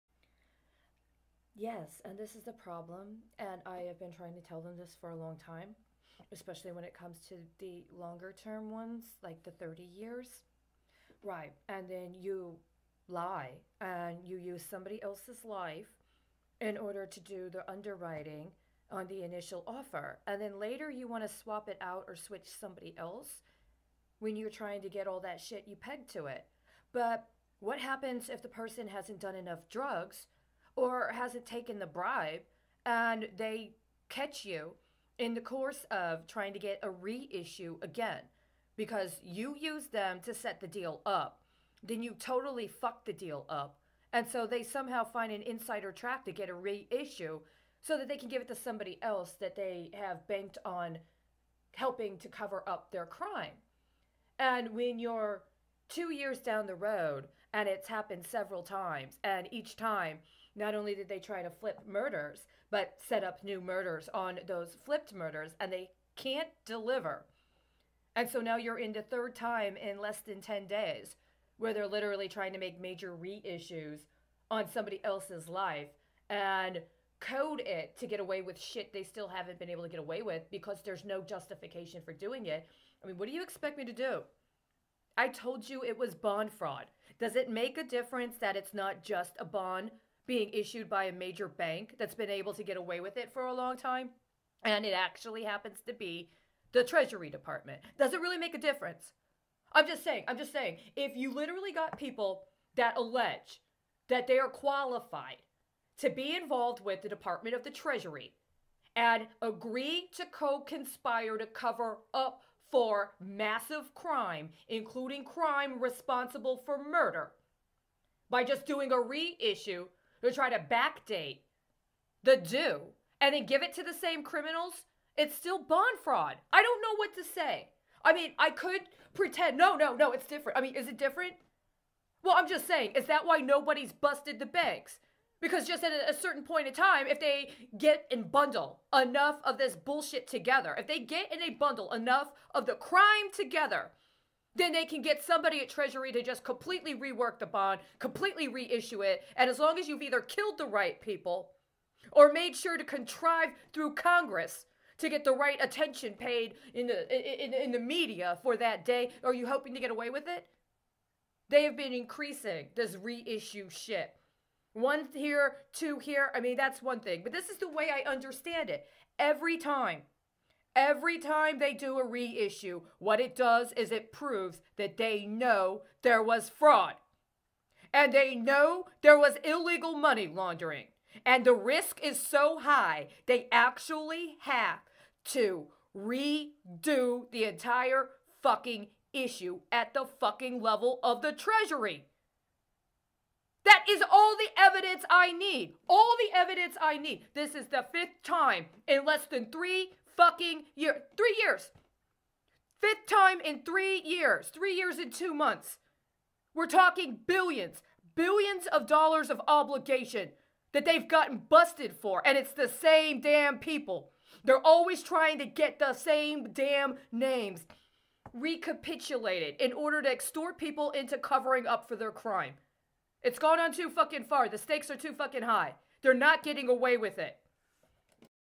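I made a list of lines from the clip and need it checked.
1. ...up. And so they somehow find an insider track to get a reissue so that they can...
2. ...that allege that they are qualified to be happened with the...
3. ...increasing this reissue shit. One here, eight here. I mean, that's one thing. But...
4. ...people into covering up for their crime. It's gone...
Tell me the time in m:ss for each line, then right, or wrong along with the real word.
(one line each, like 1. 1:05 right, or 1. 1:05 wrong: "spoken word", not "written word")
1. 0:43 right
2. 1:42 wrong: "involved", not "happened"
3. 2:41 wrong: "two", not "eight"
4. 3:40 right.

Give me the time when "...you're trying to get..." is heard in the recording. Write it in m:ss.
0:24.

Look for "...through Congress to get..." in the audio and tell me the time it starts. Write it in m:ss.
2:33.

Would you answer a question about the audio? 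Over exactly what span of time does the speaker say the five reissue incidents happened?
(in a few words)
3 years and 2 months.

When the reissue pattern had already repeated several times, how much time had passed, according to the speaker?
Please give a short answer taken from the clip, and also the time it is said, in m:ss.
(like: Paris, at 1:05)
2 years, at 0:55.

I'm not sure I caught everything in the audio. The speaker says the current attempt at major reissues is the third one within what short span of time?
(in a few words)
10 days.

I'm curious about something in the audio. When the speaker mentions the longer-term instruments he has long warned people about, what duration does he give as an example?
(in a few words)
30 years.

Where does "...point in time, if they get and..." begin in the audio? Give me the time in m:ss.
2:16.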